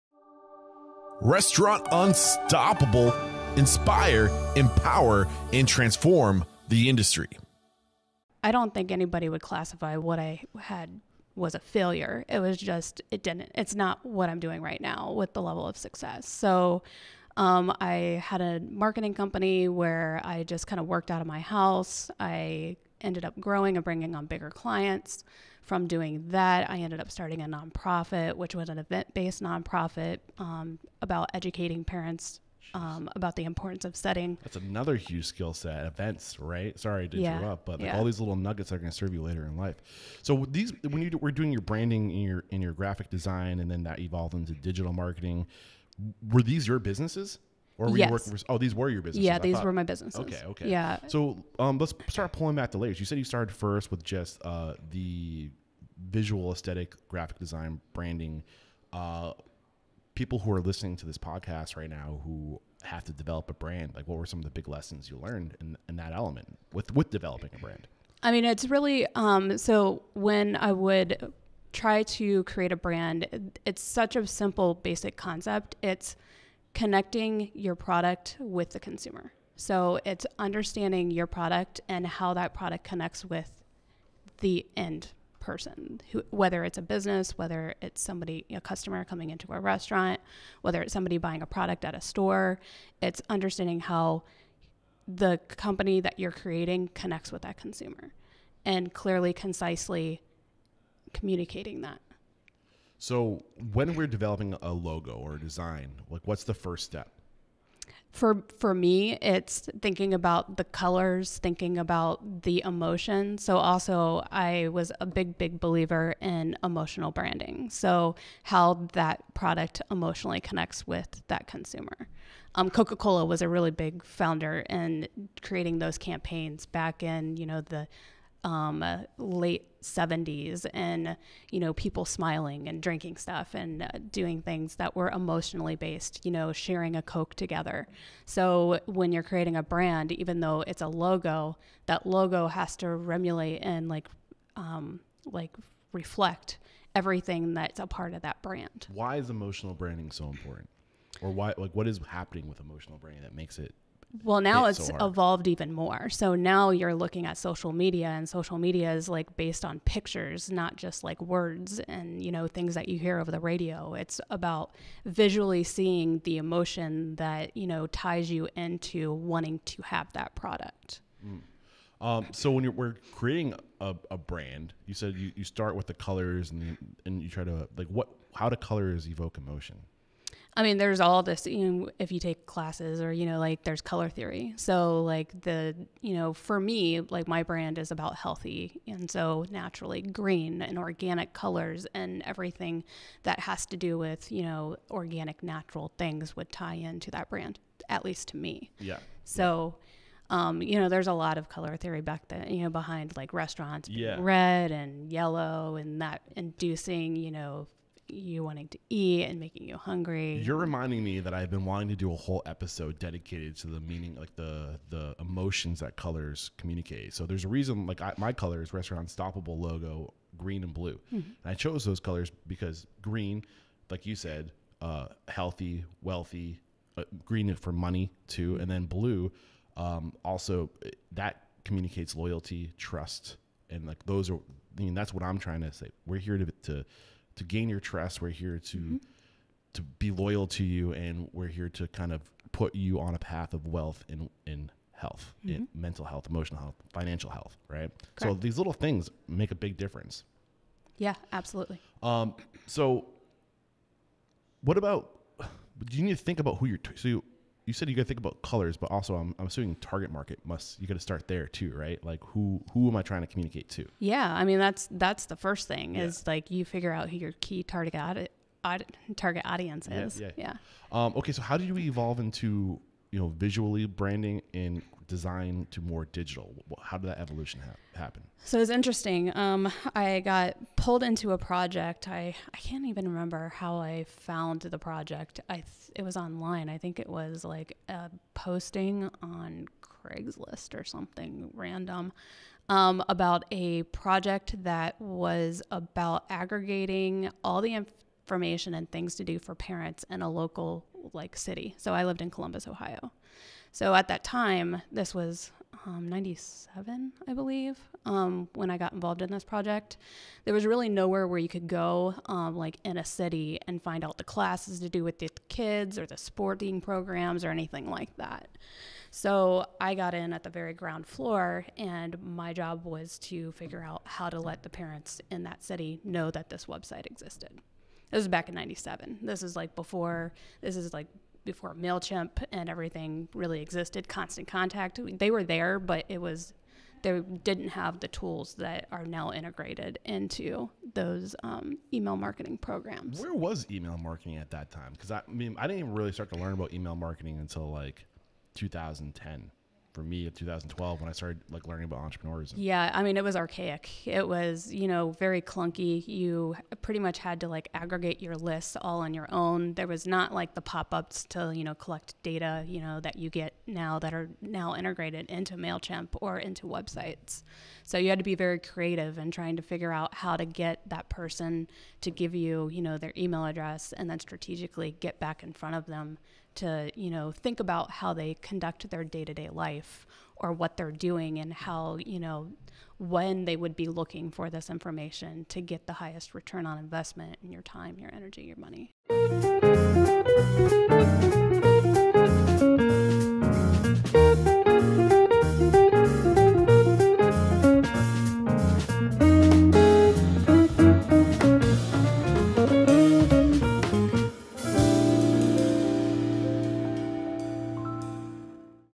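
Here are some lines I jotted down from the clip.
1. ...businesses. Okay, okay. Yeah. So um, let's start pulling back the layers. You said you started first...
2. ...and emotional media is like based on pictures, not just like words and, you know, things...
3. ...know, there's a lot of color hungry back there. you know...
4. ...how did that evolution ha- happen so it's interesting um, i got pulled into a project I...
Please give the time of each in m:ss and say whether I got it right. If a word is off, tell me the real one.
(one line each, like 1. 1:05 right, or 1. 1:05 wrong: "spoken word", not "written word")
1. 0:49 right
2. 2:38 wrong: "social", not "emotional"
3. 3:20 wrong: "theory", not "hungry"
4. 4:36 right.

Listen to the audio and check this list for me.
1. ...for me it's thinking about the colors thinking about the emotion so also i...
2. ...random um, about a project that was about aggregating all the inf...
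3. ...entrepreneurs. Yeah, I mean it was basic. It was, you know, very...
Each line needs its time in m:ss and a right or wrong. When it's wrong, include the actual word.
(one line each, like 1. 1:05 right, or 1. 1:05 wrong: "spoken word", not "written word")
1. 1:48 right
2. 4:51 right
3. 5:51 wrong: "archaic", not "basic".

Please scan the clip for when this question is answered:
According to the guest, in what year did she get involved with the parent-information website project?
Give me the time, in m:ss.
5:06.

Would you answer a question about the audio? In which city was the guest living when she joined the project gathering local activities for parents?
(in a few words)
Columbus, Ohio.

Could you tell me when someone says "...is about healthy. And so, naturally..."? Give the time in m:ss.
3:07.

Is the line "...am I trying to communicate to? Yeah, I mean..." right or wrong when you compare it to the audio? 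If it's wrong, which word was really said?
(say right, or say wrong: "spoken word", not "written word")
right.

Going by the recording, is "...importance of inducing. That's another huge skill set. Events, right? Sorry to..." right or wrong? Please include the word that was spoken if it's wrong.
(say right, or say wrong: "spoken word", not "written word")
wrong: "setting", not "inducing".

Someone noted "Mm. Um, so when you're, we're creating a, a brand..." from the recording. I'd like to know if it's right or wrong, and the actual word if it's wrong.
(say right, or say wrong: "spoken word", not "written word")
right.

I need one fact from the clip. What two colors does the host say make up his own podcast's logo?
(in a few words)
green and blue.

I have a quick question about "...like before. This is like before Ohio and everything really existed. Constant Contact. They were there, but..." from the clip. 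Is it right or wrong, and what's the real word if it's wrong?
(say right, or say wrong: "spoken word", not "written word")
wrong: "Mailchimp", not "Ohio".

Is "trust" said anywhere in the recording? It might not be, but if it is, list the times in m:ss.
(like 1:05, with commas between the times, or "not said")
3:52, 3:57.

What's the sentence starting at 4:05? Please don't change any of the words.
in mental health, emotional health, financial health, right?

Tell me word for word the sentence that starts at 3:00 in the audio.
I mean, there's all this, you know, if you take classes or, you know, like there's color theory.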